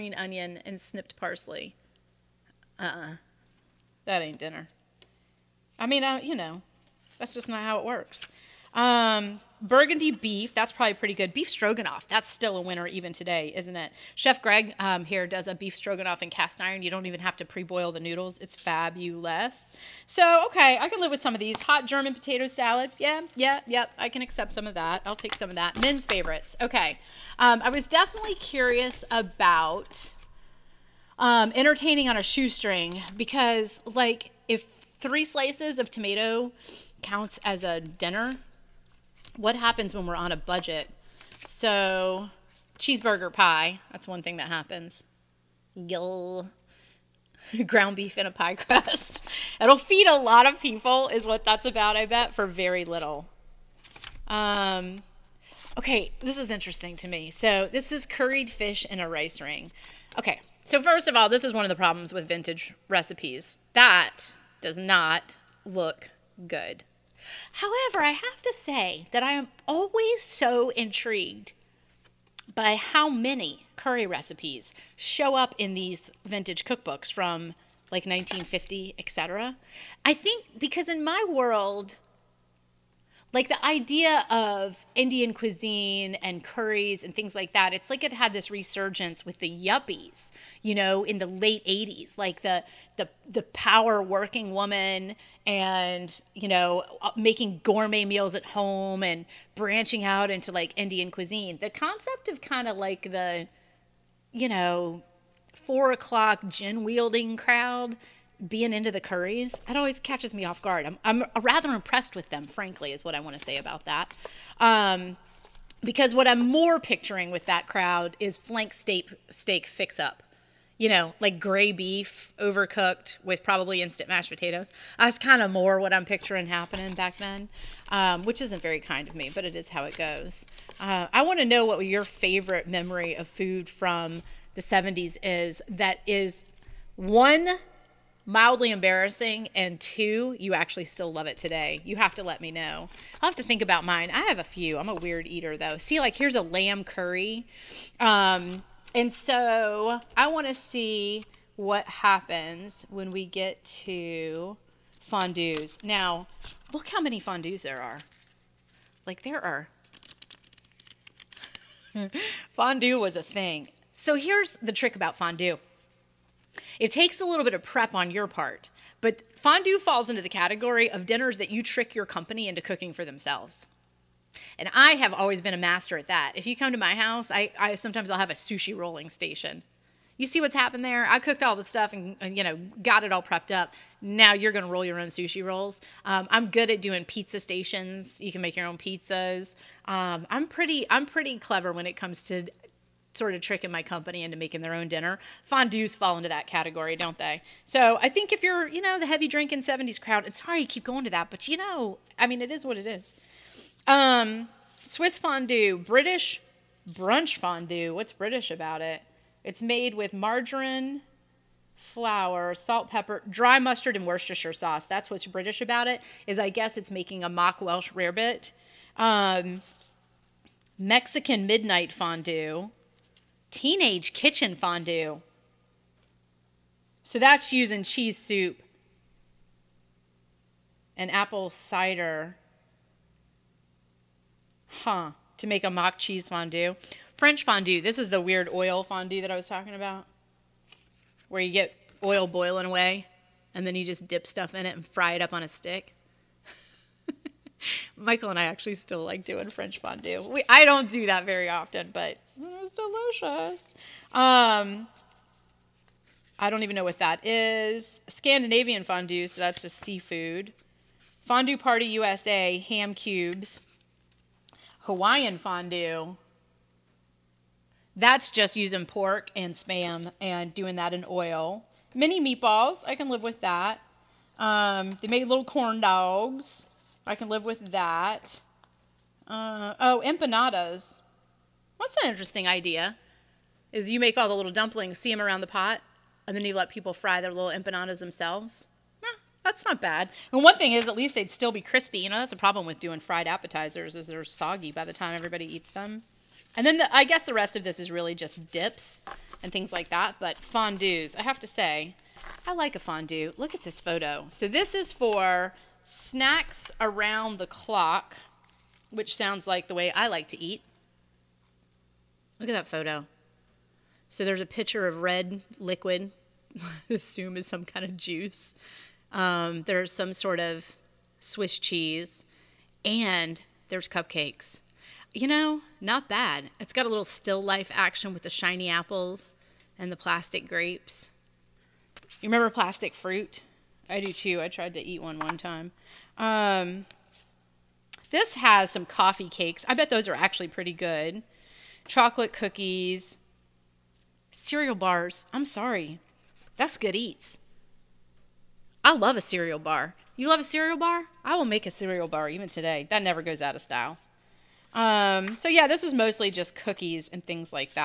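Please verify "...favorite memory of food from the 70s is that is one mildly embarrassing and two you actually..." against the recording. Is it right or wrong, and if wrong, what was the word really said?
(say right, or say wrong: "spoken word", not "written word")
right.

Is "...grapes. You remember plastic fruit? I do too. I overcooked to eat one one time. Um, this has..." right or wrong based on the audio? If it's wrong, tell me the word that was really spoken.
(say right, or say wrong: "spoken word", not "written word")
wrong: "tried", not "overcooked".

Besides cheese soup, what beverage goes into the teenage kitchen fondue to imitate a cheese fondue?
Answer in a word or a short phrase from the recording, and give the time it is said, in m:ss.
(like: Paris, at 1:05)
Apple cider, at 3:51.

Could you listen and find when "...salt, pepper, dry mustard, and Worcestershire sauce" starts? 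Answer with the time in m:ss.
3:32.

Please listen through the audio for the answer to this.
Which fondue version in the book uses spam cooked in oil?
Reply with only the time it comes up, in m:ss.
4:24.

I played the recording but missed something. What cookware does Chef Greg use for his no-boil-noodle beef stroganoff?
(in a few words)
Cast iron.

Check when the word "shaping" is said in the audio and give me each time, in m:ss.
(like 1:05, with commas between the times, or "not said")
not said.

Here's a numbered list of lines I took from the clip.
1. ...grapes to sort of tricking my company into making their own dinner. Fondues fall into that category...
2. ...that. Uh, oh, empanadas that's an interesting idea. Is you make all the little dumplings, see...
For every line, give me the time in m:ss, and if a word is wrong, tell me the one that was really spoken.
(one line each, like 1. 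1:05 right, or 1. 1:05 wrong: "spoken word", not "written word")
1. 3:11 wrong: "comes", not "grapes"
2. 4:37 right.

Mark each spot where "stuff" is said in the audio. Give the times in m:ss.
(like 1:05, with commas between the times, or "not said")
3:01, 4:04.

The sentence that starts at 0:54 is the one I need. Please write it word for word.
Um, okay, this is interesting to me.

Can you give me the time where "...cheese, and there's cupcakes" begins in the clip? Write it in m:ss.
5:21.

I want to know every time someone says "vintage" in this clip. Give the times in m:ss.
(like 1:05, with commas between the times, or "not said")
1:02, 1:16.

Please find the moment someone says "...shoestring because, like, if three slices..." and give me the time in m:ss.
0:32.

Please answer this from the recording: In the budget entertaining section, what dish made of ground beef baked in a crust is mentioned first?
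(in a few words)
Cheeseburger pie.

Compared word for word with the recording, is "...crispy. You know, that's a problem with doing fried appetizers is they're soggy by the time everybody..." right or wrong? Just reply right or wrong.
right.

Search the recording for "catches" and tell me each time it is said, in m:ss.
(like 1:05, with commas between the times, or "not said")
1:49.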